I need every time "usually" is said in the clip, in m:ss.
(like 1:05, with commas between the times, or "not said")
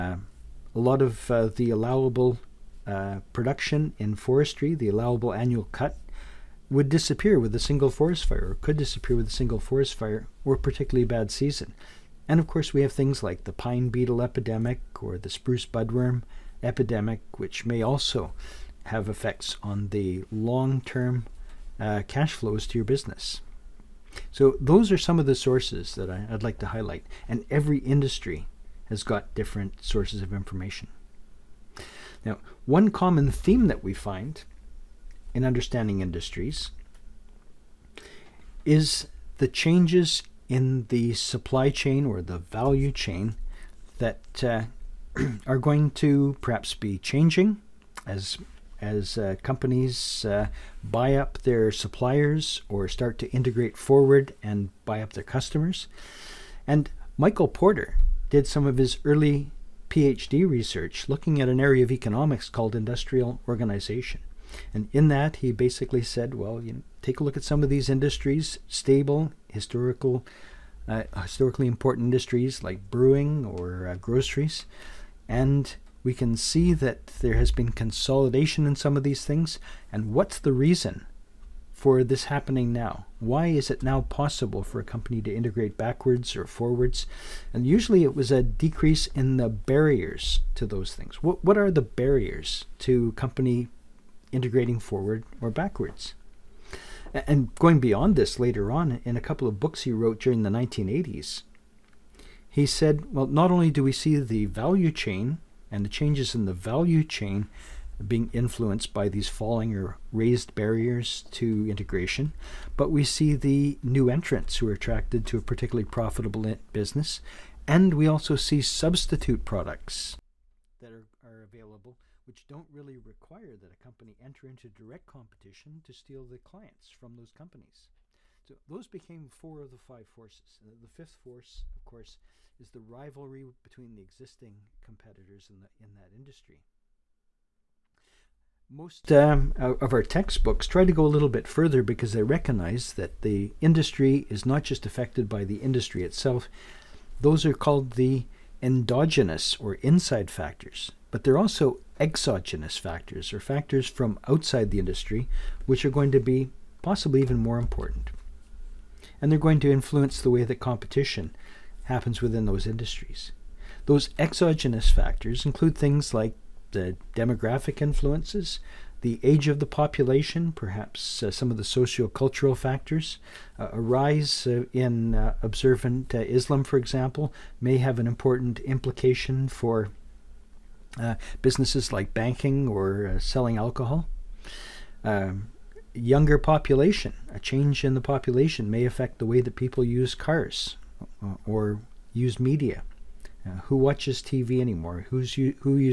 1:27.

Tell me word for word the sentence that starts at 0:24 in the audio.
So those are some of the sources that I, would like to highlight.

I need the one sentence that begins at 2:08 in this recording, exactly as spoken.
So those became four of the five forces.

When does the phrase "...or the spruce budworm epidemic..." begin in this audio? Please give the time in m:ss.
0:15.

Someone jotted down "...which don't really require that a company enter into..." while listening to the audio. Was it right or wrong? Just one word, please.
right.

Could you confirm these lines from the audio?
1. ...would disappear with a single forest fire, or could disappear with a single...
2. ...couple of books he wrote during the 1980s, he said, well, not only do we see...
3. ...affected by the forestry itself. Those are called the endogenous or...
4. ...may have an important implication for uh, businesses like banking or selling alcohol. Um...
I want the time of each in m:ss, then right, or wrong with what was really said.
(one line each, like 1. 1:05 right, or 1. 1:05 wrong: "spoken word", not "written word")
1. 0:06 right
2. 1:39 right
3. 2:24 wrong: "industry", not "forestry"
4. 2:57 right.